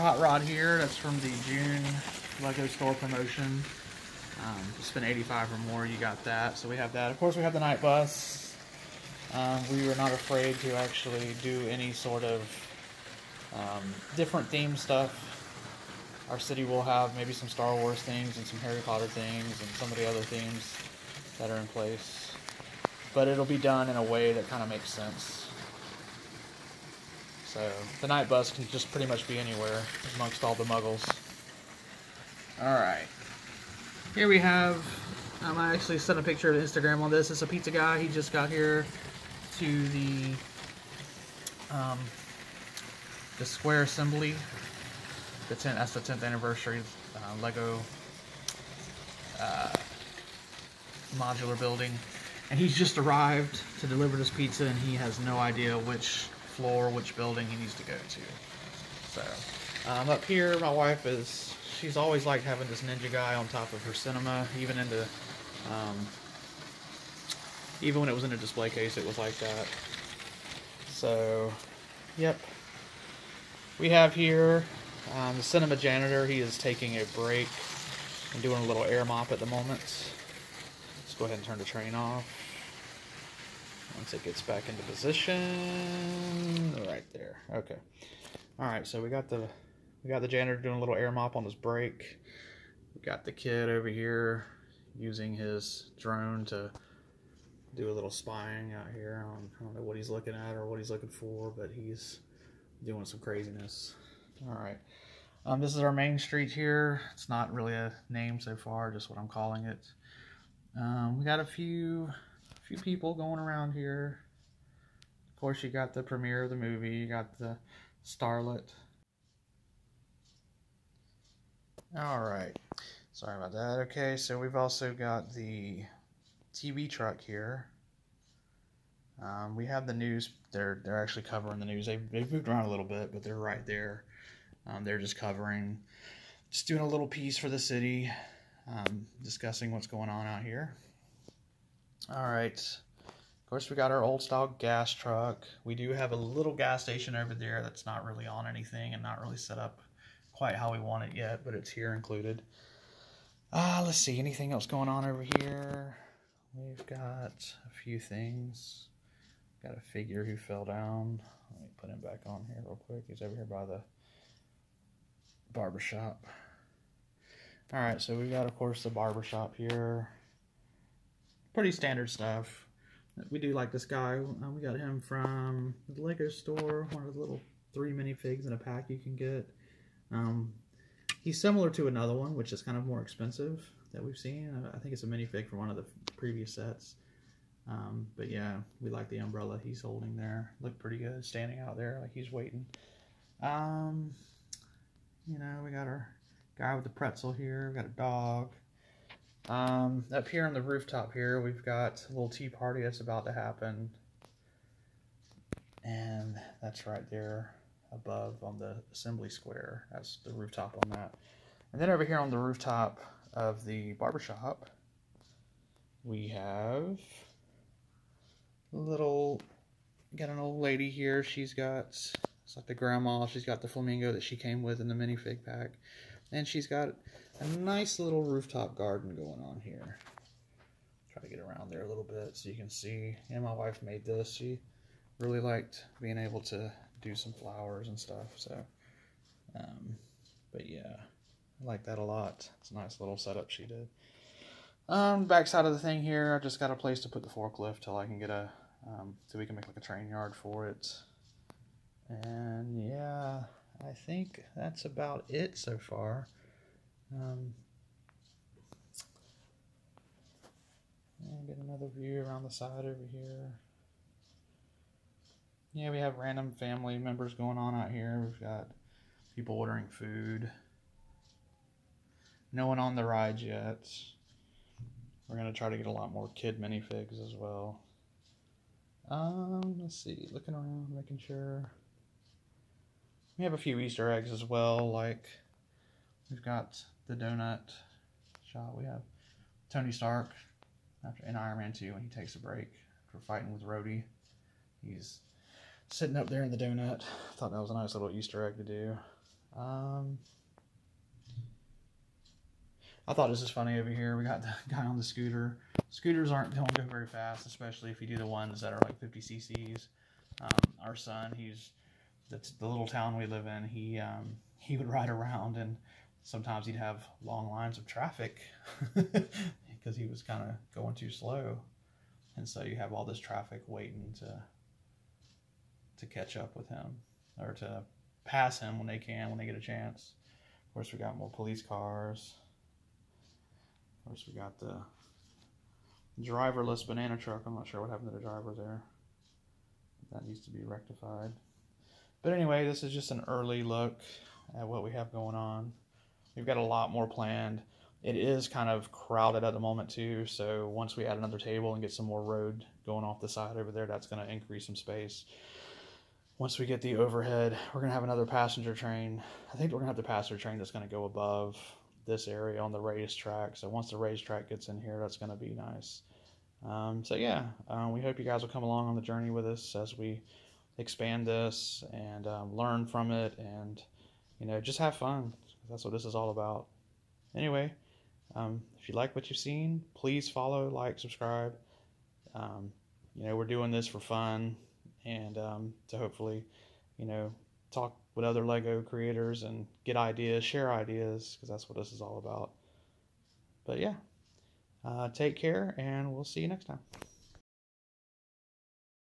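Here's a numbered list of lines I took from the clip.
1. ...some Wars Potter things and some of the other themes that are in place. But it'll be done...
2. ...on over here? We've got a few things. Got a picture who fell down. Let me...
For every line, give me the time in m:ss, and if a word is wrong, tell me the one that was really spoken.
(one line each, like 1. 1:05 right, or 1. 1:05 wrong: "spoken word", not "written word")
1. 0:18 wrong: "Harry", not "Wars"
2. 2:34 wrong: "figure", not "picture".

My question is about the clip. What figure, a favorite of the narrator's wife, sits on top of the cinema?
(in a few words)
ninja guy.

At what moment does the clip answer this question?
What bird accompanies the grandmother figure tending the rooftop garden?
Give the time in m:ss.
3:43.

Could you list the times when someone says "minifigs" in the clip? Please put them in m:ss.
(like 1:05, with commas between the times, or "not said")
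2:57, 3:05, 3:44, 4:36.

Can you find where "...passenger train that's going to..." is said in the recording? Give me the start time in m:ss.
6:00.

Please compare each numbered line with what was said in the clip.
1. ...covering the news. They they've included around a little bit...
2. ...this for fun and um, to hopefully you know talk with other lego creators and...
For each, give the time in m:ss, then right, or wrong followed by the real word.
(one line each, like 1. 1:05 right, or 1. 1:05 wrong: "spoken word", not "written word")
1. 2:11 wrong: "moved", not "included"
2. 6:23 right.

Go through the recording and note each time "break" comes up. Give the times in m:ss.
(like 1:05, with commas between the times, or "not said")
1:17, 1:31, 4:52.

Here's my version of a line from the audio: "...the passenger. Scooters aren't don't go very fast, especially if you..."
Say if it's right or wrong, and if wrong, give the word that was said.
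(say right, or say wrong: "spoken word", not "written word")
wrong: "scooter", not "passenger".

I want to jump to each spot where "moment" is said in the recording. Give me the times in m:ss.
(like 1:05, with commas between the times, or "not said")
1:19, 5:49.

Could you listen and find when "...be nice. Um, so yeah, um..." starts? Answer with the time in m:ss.
6:05.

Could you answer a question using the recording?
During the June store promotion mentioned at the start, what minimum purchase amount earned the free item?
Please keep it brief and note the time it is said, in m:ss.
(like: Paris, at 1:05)
85, at 0:05.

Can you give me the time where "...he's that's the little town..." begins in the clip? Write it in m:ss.
5:11.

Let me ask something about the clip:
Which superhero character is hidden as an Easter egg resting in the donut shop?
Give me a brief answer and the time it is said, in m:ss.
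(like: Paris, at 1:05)
Tony Stark, at 4:49.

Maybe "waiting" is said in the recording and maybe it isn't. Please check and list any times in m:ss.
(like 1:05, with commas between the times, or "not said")
3:12, 5:23.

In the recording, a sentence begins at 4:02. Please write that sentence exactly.
It's a nice little setup she did.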